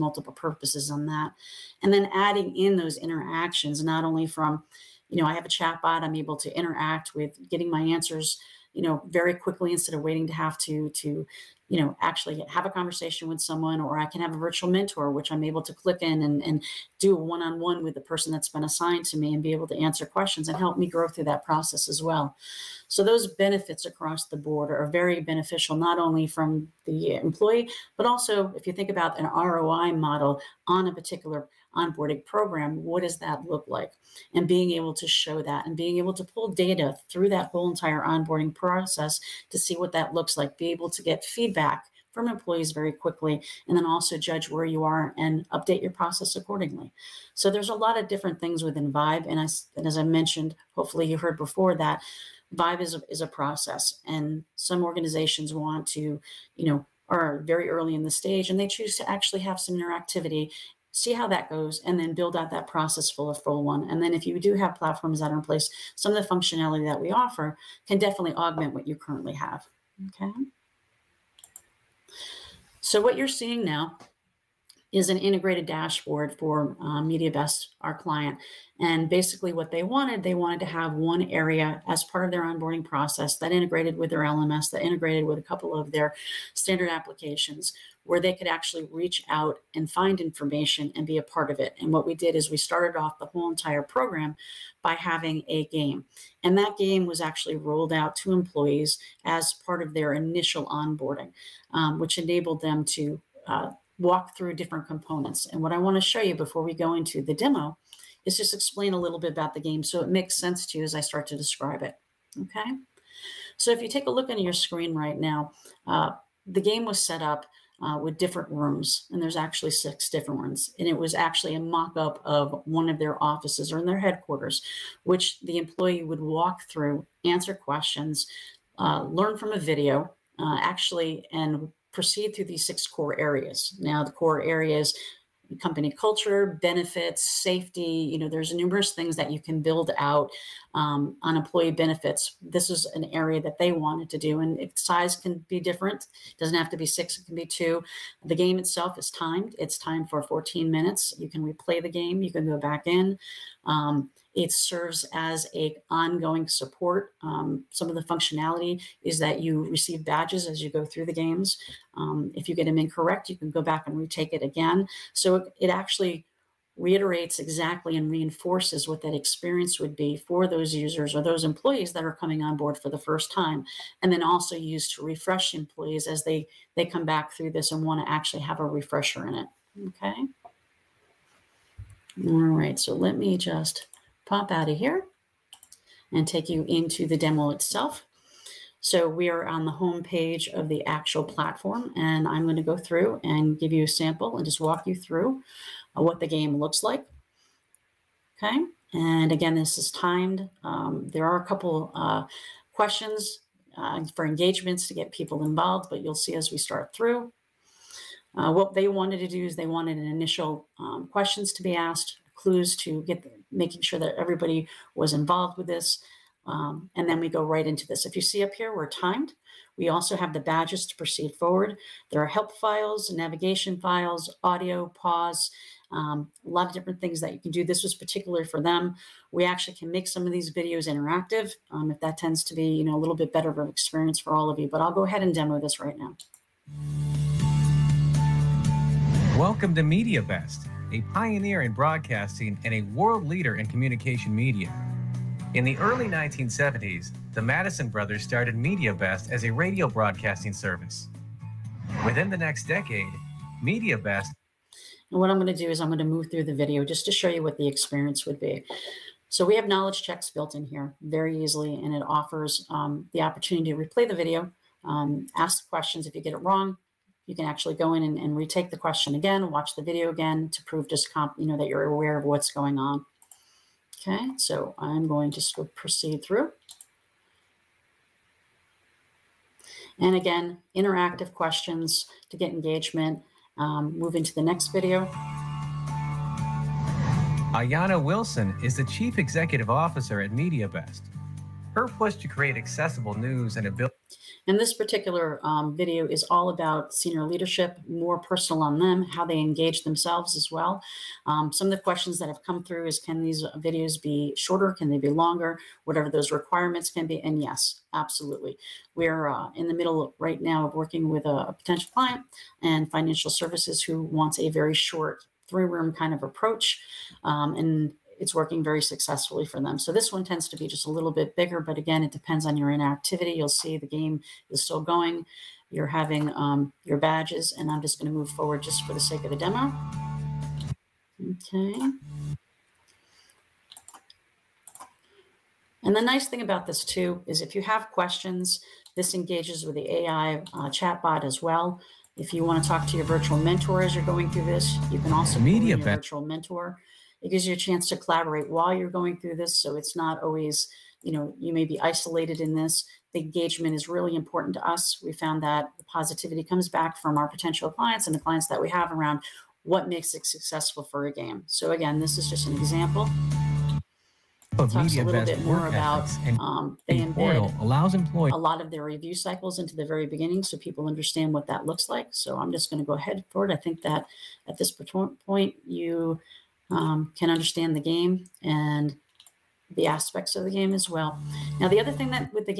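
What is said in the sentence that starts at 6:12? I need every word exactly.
So I'm just going to go ahead forward.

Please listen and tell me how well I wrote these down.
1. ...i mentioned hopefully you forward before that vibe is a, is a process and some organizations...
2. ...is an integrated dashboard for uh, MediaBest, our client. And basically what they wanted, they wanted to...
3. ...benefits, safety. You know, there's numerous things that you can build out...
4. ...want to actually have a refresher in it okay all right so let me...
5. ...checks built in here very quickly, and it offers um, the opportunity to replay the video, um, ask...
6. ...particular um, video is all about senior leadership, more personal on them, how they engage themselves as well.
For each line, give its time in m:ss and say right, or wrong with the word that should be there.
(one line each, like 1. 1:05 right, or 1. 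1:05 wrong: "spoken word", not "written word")
1. 0:49 wrong: "heard", not "forward"
2. 1:14 right
3. 2:16 right
4. 2:57 right
5. 4:20 wrong: "easily", not "quickly"
6. 4:54 right.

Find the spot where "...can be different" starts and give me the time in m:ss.
2:25.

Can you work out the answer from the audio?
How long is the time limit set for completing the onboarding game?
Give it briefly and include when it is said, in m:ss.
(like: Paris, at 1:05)
14 minutes, at 2:30.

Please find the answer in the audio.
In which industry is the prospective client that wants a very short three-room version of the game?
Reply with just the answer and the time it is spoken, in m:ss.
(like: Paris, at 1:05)
Financial services, at 5:12.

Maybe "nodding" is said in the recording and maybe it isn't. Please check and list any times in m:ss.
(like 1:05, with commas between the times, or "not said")
not said.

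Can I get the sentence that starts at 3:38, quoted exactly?
If you see up here, we're timed.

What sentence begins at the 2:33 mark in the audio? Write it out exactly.
Um, it serves as a ongoing support.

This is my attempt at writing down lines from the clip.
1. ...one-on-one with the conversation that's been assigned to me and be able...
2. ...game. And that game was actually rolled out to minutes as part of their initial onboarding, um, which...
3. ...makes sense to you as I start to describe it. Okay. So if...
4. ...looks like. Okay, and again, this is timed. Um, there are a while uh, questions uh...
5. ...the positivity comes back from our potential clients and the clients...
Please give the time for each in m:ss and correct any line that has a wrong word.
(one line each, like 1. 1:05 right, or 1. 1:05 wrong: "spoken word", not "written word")
1. 0:17 wrong: "person", not "conversation"
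2. 1:35 wrong: "employees", not "minutes"
3. 1:50 right
4. 3:16 wrong: "couple", not "while"
5. 5:55 right.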